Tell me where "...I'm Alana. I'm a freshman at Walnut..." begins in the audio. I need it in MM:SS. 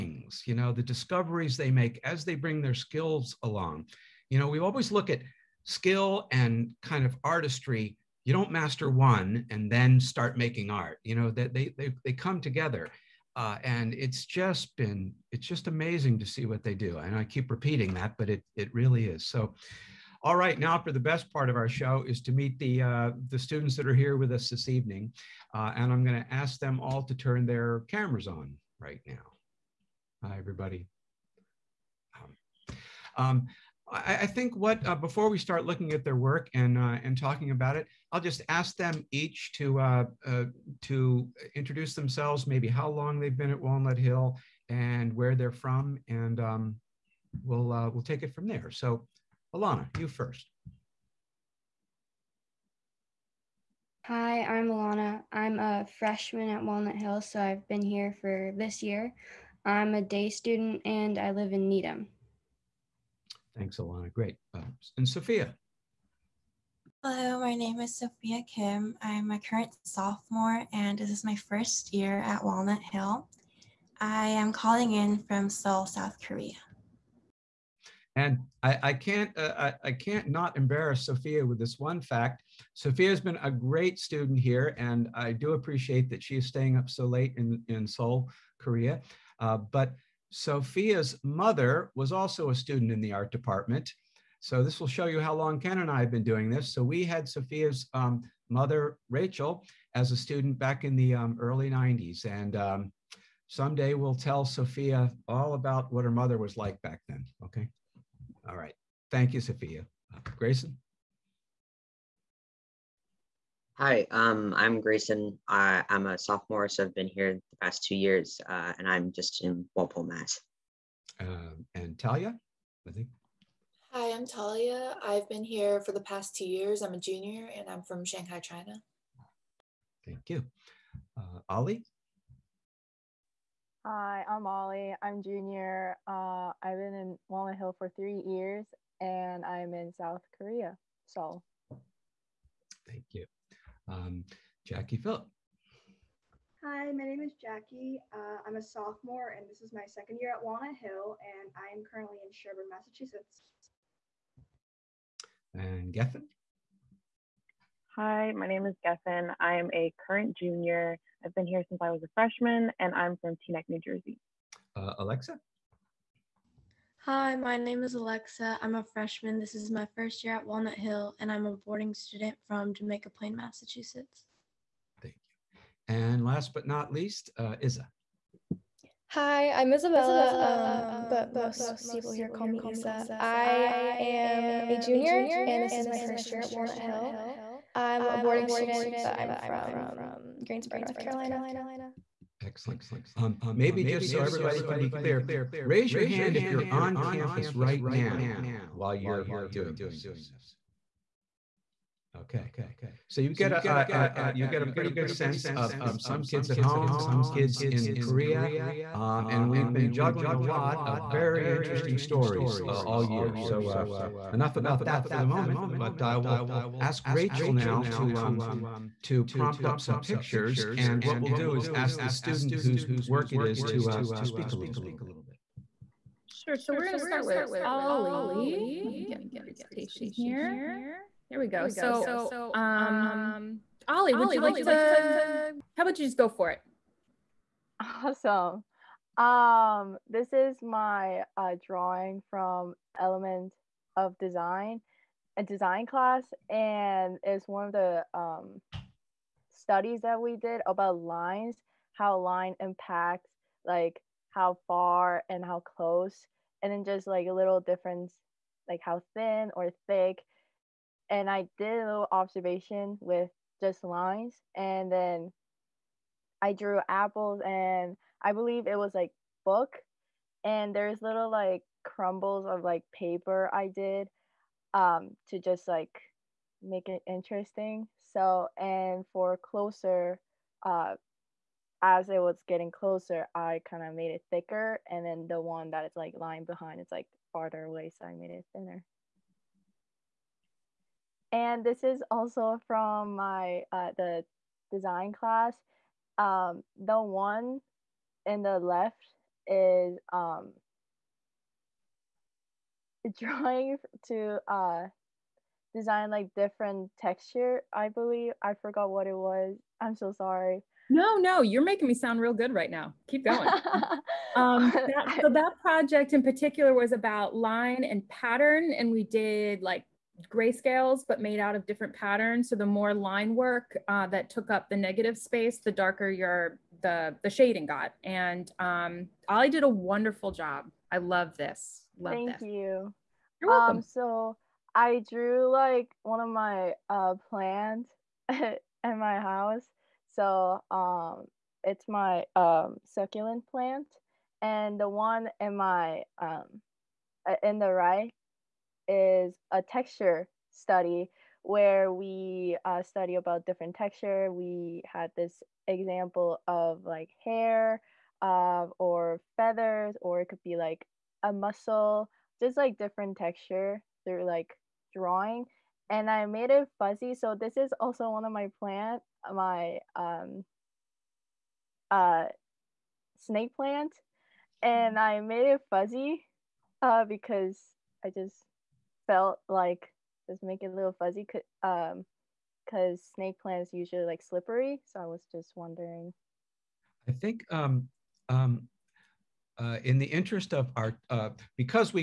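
00:54.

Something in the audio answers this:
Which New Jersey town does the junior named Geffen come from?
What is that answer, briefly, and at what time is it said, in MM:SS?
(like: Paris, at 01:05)
Teaneck, at 02:43.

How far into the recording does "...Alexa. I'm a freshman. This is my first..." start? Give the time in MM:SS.
02:47.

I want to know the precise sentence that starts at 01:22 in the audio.
Sophia has been a great student here, and I do appreciate that she is staying up so late in, in Seoul, Korea.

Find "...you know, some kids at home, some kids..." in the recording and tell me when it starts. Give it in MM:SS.
03:25.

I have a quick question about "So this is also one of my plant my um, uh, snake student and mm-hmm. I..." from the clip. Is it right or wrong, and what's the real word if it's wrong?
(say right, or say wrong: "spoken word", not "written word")
wrong: "plant", not "student".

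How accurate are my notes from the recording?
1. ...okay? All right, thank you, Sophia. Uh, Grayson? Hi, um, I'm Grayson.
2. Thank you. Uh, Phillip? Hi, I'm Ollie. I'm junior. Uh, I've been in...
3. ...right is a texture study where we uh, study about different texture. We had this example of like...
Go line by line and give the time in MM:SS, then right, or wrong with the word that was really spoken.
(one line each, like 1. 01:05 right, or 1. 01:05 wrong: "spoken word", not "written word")
1. 01:47 right
2. 02:10 wrong: "Ollie", not "Phillip"
3. 05:47 right.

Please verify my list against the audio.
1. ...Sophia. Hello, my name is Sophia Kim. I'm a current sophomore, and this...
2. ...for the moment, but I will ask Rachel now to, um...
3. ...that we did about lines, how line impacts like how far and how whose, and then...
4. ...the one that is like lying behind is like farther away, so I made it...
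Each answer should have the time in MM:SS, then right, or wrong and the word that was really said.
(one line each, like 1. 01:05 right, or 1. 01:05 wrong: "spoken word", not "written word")
1. 01:05 right
2. 03:35 right
3. 04:10 wrong: "close", not "whose"
4. 04:45 right.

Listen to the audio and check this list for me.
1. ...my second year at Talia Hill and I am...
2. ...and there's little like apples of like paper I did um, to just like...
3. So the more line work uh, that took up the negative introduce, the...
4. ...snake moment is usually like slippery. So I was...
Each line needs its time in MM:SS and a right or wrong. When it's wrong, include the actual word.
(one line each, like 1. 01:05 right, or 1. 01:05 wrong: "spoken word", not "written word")
1. 02:29 wrong: "Walnut", not "Talia"
2. 04:30 wrong: "crumbles", not "apples"
3. 05:22 wrong: "space", not "introduce"
4. 06:23 wrong: "plant", not "moment".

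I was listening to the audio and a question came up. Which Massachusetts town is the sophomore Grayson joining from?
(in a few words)
Walpole.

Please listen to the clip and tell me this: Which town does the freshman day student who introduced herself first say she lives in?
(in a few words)
Needham.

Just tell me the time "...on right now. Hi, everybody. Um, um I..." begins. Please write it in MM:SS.
00:28.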